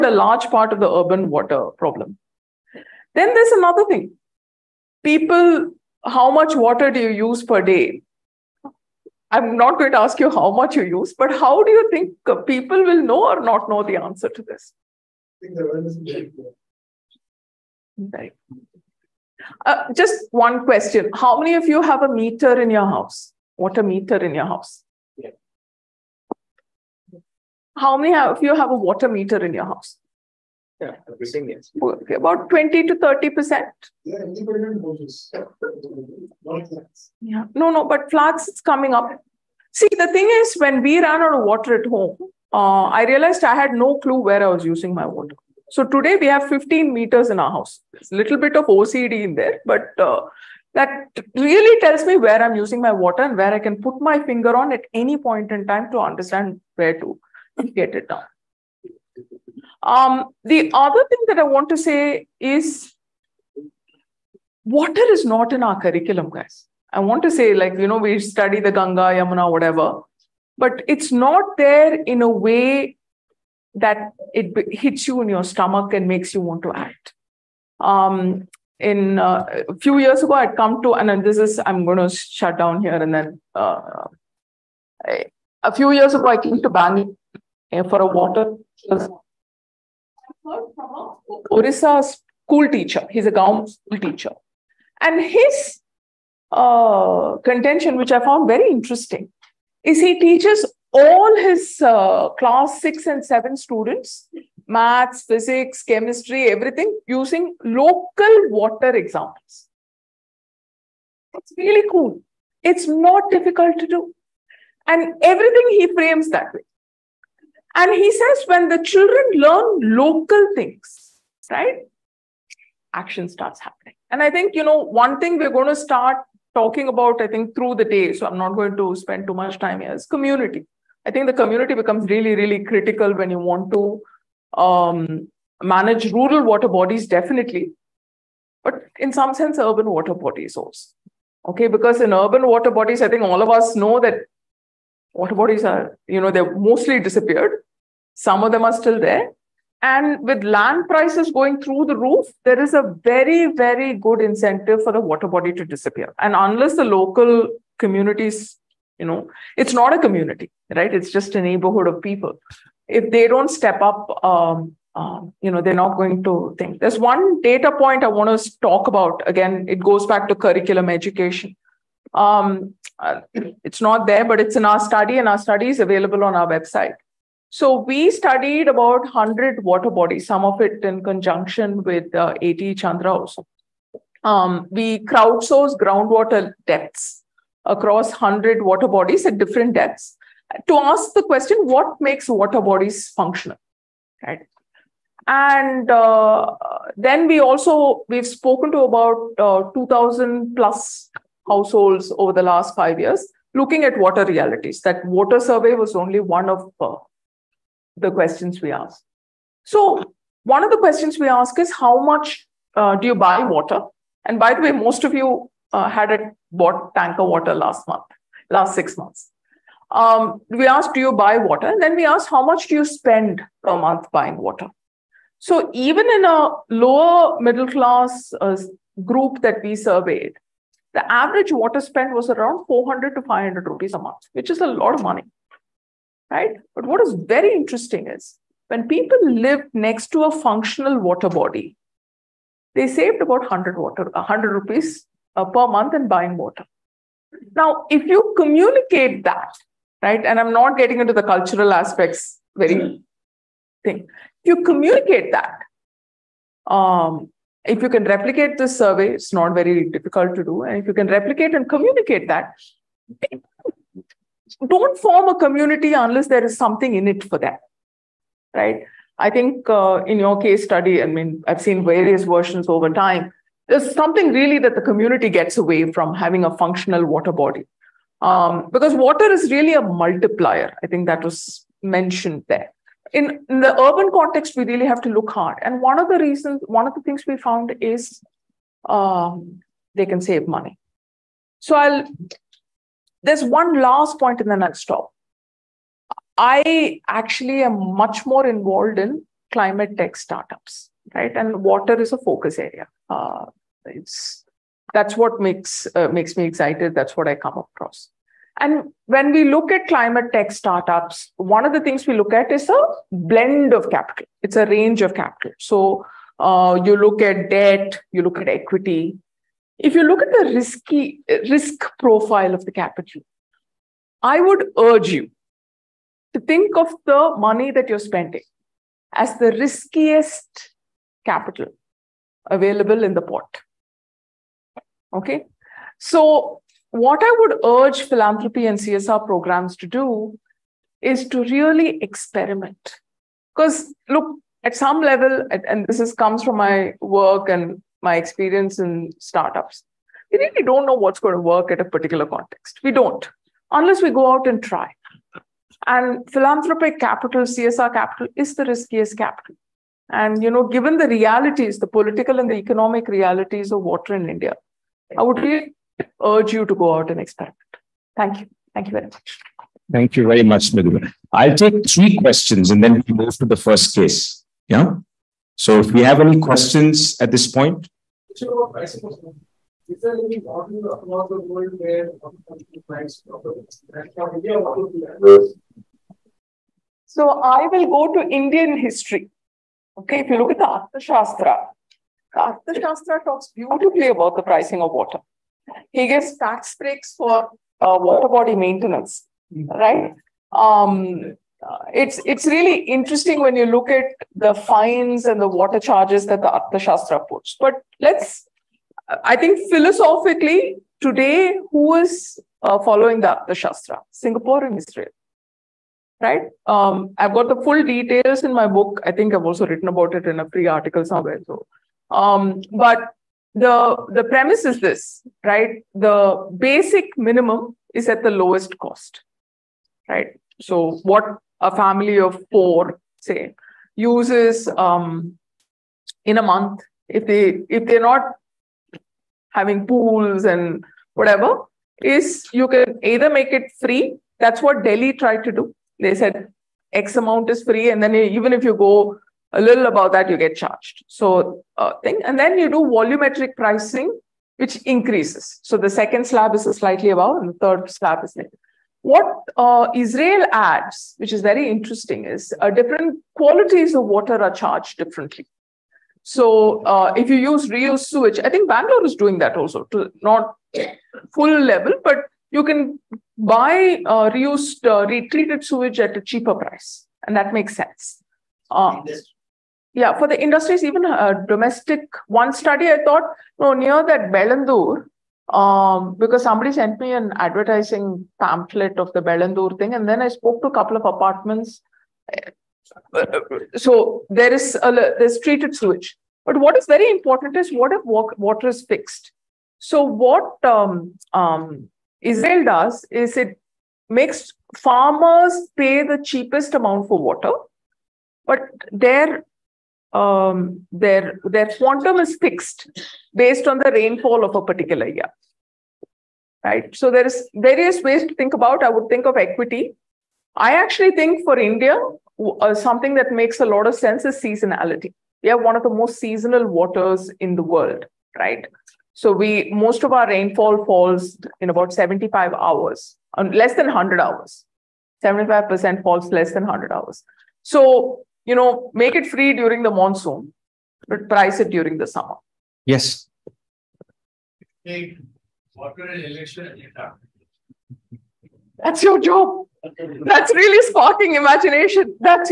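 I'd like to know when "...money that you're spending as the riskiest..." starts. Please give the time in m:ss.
5:27.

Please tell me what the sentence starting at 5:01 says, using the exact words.
And water is a focus area uh, it's that's what makes uh, makes me excited.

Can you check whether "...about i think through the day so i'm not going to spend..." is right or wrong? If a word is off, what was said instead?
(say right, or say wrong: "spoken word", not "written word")
right.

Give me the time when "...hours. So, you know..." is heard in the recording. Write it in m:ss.
8:56.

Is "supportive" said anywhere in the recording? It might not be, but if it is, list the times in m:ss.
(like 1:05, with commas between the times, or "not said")
not said.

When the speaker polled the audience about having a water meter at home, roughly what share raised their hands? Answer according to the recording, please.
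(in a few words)
20 to 30 percent.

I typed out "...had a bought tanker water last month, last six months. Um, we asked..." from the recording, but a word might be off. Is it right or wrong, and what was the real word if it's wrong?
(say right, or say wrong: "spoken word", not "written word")
right.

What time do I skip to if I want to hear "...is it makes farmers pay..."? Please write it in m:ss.
8:23.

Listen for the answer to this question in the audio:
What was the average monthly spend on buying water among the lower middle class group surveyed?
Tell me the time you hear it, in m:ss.
3:52.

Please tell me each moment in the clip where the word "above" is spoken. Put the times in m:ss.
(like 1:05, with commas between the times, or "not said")
7:29, 7:37.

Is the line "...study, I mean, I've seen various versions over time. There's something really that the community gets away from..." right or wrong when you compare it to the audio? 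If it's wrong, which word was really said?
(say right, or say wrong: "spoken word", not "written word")
right.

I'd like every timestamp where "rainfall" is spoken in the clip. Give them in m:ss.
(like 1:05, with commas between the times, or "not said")
8:33, 8:50.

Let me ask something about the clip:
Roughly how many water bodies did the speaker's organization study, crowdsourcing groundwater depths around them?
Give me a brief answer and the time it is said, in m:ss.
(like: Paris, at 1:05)
100, at 2:58.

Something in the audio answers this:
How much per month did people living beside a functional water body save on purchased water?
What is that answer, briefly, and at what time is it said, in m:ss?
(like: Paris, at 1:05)
100 rupees, at 4:04.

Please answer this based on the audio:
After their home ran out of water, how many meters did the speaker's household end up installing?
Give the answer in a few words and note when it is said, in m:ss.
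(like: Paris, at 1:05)
15, at 0:46.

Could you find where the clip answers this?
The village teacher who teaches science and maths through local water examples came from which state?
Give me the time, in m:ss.
1:31.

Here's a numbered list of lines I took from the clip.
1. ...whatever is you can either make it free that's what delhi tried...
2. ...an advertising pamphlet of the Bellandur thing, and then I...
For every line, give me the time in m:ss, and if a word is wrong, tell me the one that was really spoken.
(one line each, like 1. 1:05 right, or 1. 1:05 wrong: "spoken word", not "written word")
1. 7:21 right
2. 8:07 right.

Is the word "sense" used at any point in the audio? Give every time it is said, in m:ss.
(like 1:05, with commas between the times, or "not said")
2:19, 7:57, 8:43.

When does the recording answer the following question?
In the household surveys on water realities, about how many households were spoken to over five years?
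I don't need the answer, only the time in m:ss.
3:19.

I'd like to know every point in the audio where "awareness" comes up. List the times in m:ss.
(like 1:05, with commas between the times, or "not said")
0:15.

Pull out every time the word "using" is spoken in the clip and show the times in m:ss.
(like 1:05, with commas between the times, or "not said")
0:44, 0:52, 1:47.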